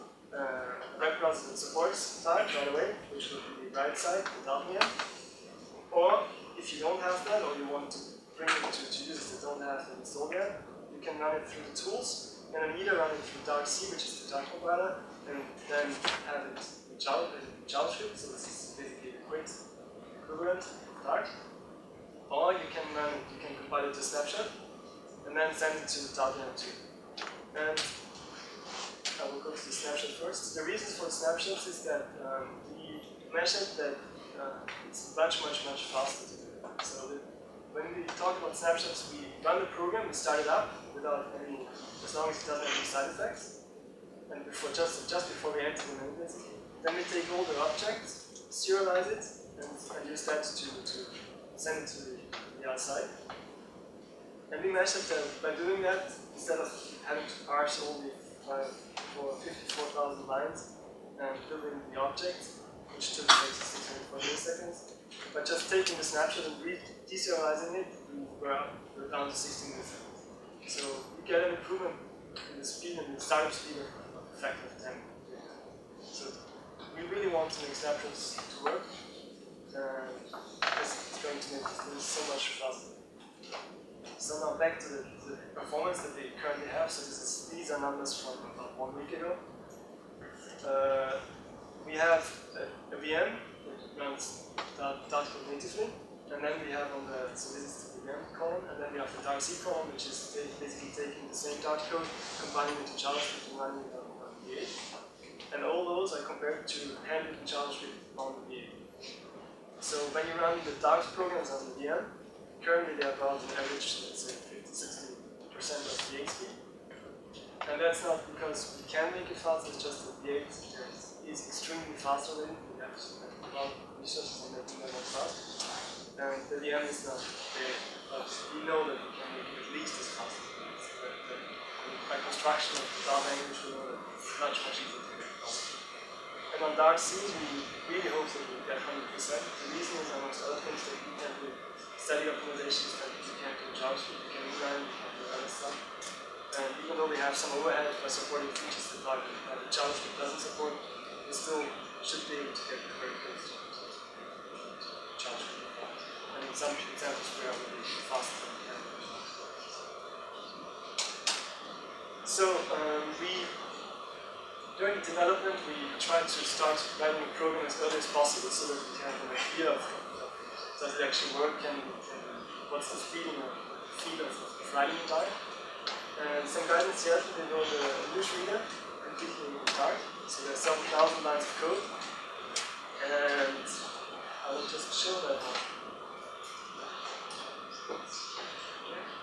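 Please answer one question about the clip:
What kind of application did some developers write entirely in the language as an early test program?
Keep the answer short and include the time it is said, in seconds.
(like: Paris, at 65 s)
newsreader, at 178 s.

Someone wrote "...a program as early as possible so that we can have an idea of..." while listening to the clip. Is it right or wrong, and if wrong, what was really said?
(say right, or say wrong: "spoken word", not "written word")
right.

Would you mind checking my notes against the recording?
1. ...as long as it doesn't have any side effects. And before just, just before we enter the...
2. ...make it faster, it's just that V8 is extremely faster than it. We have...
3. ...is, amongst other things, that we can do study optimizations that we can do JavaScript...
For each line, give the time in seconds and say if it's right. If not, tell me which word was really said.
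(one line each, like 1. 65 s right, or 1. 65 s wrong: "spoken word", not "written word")
1. 42 s right
2. 119 s right
3. 140 s right.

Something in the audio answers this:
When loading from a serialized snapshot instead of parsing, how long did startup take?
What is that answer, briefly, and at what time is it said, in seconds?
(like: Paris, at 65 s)
16 milliseconds, at 69 s.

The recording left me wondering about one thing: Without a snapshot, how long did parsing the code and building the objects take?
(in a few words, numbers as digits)
624 milliseconds.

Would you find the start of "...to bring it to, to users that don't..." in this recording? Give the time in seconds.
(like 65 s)
7 s.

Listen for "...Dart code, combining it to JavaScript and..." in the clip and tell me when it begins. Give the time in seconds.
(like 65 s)
101 s.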